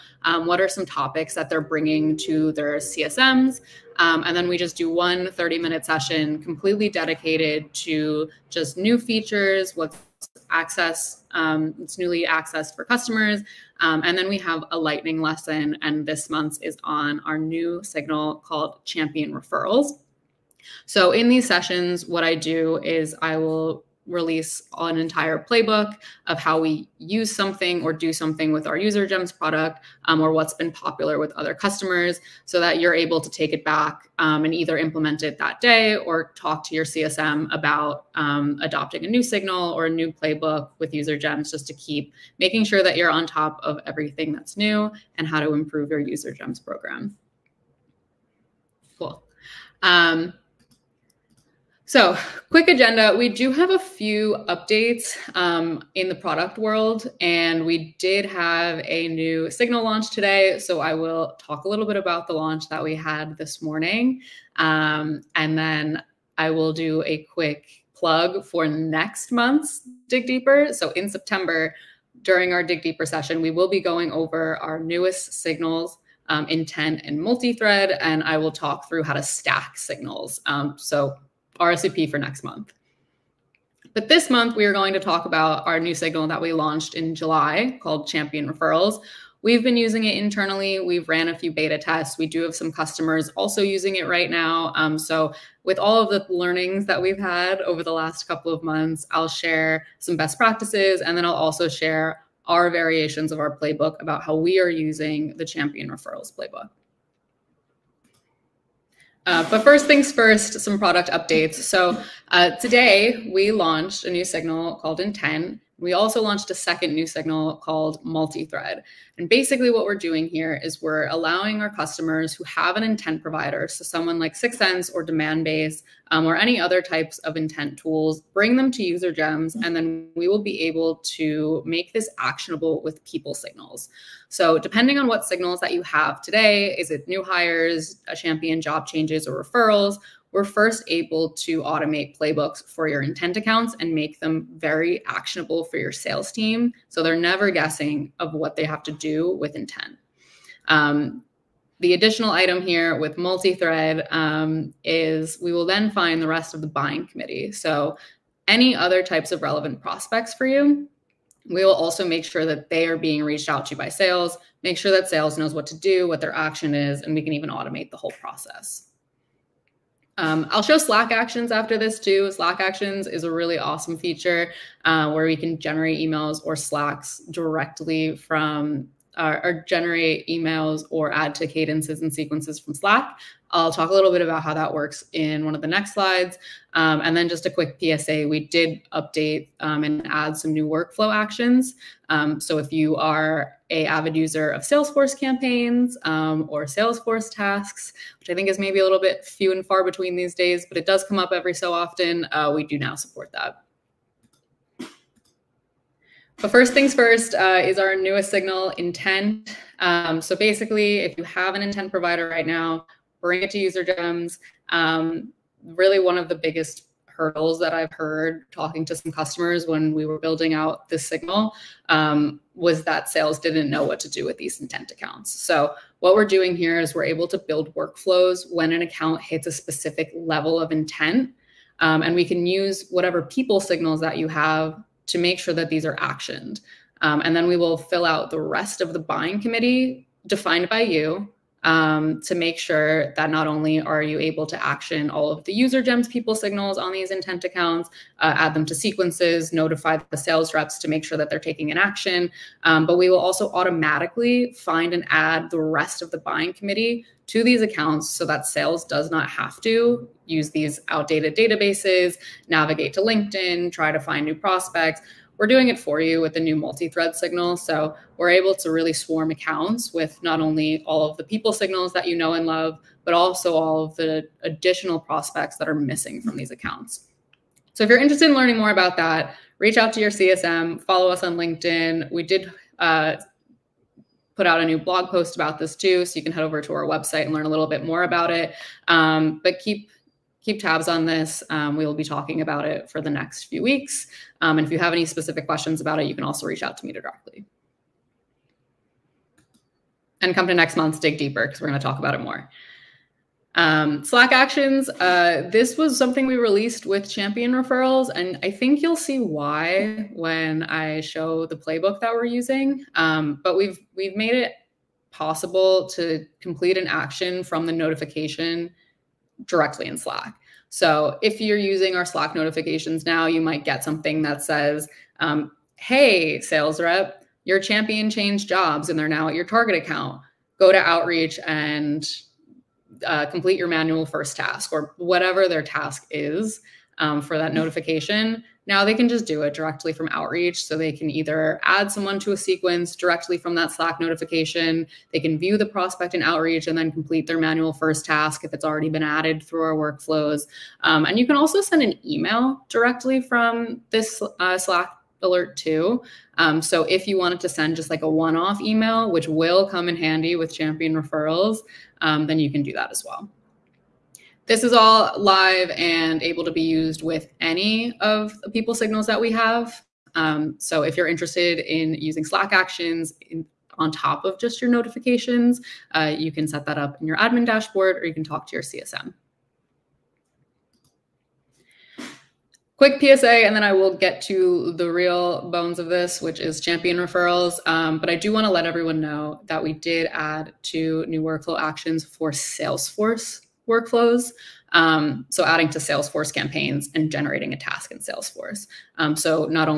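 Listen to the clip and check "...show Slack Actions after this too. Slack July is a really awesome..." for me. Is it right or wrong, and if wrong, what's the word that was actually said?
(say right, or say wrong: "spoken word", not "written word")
wrong: "Actions", not "July".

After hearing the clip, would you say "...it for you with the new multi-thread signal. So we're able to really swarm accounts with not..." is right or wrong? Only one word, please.
right.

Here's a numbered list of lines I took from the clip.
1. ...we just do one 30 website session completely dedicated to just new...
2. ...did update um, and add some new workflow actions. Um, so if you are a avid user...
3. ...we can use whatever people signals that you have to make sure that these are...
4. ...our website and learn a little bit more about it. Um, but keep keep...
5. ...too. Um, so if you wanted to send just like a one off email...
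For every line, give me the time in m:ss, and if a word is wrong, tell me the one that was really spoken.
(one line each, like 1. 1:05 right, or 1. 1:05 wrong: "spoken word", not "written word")
1. 0:04 wrong: "minute", not "website"
2. 3:08 right
3. 3:52 right
4. 4:46 right
5. 5:55 right.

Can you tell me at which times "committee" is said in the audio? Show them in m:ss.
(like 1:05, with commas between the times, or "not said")
2:37, 3:59, 4:16.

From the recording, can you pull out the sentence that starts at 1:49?
Uh, but first things first, some product updates.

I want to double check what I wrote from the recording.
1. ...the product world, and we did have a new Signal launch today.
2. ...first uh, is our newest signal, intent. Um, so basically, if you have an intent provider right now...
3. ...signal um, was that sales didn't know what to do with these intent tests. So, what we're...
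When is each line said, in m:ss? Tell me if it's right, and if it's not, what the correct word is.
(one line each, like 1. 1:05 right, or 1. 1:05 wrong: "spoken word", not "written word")
1. 0:56 right
2. 3:26 right
3. 3:41 wrong: "accounts", not "tests".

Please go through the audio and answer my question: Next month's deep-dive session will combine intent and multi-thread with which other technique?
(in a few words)
stack signals.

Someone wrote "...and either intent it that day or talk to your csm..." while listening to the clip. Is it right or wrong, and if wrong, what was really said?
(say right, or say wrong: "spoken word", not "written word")
wrong: "implement", not "intent".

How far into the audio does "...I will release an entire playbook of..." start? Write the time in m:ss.
0:23.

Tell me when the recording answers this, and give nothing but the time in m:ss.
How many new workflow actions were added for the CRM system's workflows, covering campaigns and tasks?
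6:30.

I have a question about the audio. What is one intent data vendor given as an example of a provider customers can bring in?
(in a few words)
6sense or Demandbase.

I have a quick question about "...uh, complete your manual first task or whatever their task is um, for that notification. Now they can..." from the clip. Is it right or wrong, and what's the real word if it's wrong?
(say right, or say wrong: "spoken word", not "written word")
right.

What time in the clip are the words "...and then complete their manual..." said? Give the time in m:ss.
5:46.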